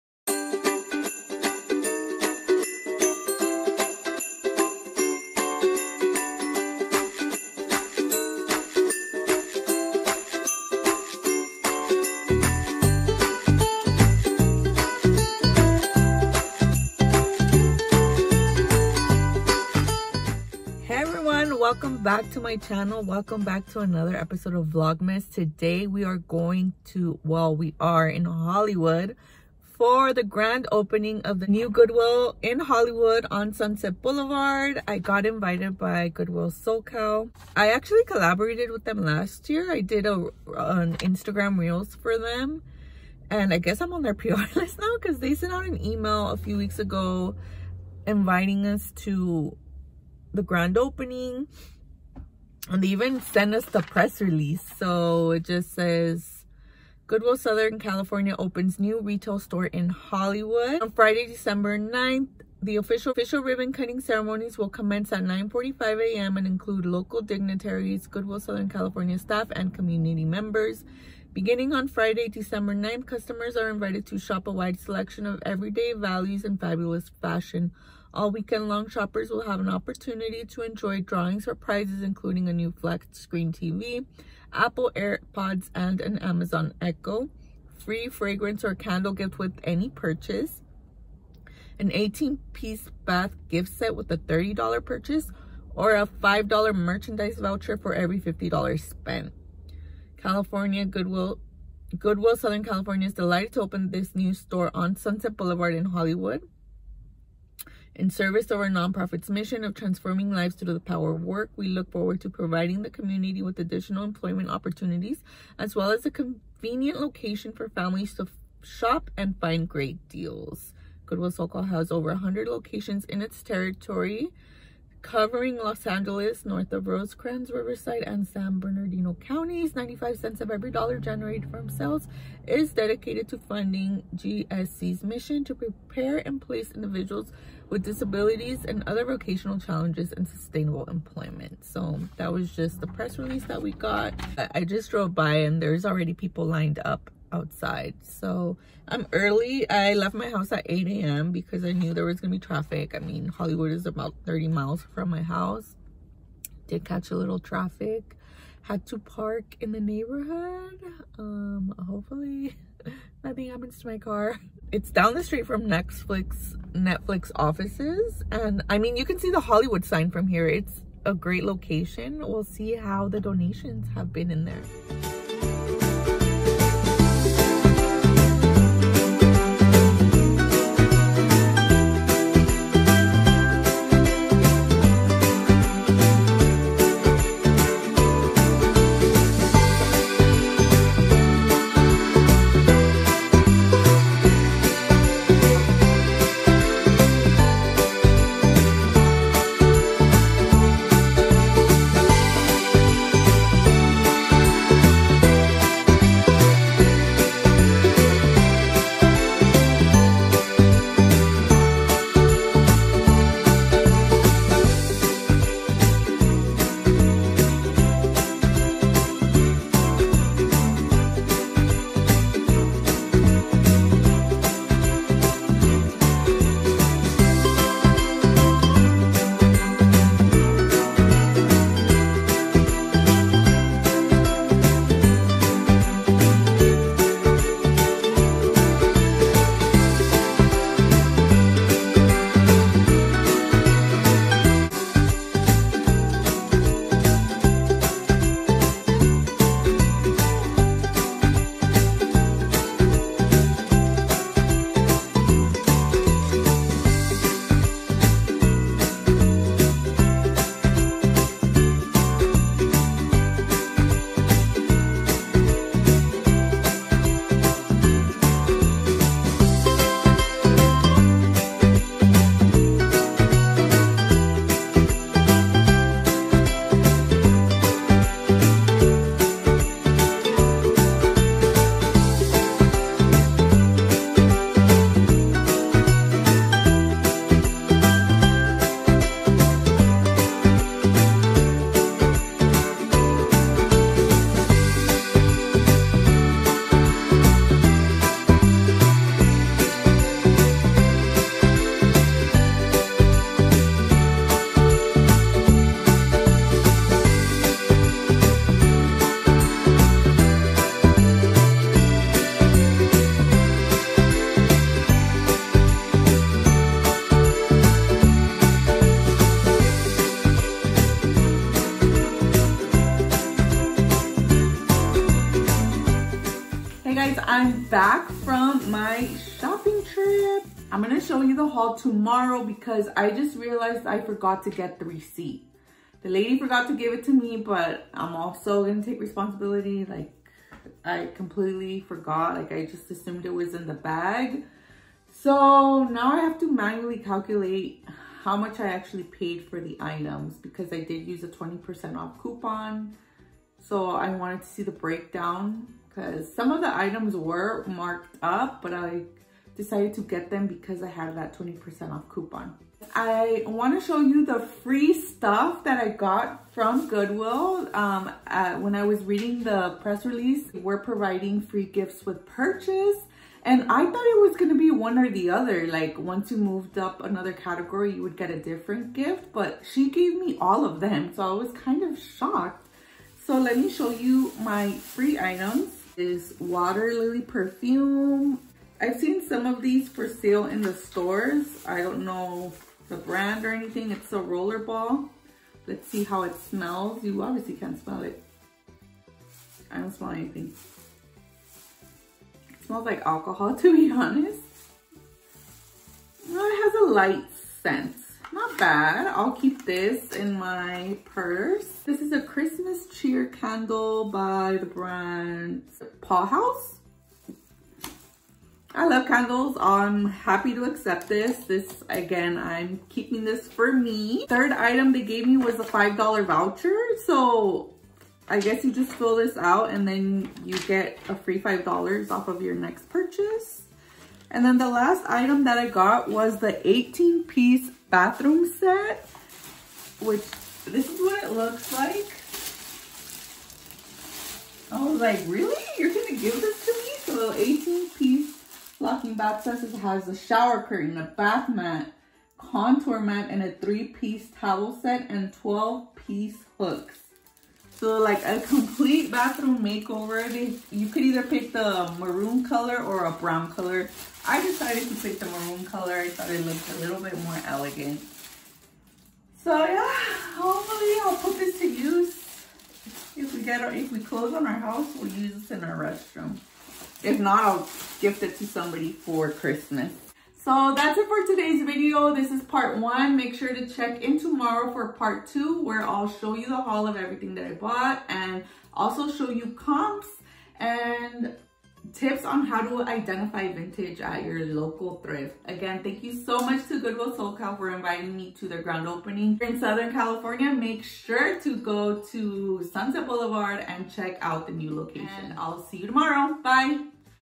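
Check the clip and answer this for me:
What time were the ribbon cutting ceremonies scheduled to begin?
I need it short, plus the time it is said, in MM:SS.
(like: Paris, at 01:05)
9:45 a.m., at 01:05.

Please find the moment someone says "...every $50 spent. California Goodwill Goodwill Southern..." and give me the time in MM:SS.
01:37.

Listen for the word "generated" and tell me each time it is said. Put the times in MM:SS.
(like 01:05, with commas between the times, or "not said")
02:10.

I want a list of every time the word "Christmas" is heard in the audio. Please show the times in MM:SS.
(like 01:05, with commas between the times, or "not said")
06:52, 07:59.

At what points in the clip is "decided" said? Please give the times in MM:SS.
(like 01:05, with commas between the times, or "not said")
05:59, 07:44.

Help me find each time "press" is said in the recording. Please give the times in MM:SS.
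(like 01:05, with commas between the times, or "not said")
00:53, 02:22, 06:09.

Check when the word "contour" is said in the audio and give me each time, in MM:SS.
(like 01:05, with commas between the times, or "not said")
07:32.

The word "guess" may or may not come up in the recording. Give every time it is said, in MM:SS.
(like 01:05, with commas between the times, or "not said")
00:43, 07:08.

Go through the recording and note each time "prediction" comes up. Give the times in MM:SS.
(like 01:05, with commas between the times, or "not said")
not said.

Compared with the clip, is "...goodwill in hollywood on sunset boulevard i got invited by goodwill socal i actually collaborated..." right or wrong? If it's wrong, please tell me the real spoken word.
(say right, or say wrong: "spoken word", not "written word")
right.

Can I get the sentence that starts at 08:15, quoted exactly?
Again, thank you so much to Goodwill SoCal for inviting me to their grand opening.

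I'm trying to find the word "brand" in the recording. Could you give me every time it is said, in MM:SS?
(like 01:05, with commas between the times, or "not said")
06:32, 06:54.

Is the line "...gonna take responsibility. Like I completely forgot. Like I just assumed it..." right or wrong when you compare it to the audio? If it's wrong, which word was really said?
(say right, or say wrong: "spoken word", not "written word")
right.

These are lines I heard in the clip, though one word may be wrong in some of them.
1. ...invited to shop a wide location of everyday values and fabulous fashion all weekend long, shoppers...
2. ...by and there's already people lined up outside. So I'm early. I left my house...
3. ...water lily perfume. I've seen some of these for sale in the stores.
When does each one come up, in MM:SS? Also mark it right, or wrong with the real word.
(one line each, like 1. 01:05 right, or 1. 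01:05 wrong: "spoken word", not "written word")
1. 01:13 wrong: "selection", not "location"
2. 02:25 right
3. 06:26 right.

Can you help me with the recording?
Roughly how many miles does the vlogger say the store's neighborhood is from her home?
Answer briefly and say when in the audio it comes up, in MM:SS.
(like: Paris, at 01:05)
30 miles, at 02:34.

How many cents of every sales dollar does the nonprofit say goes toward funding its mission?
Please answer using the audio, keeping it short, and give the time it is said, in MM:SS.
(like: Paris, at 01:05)
95, at 02:09.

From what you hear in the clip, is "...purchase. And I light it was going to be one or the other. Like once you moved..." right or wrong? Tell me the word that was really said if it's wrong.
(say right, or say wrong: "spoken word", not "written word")
wrong: "thought", not "light".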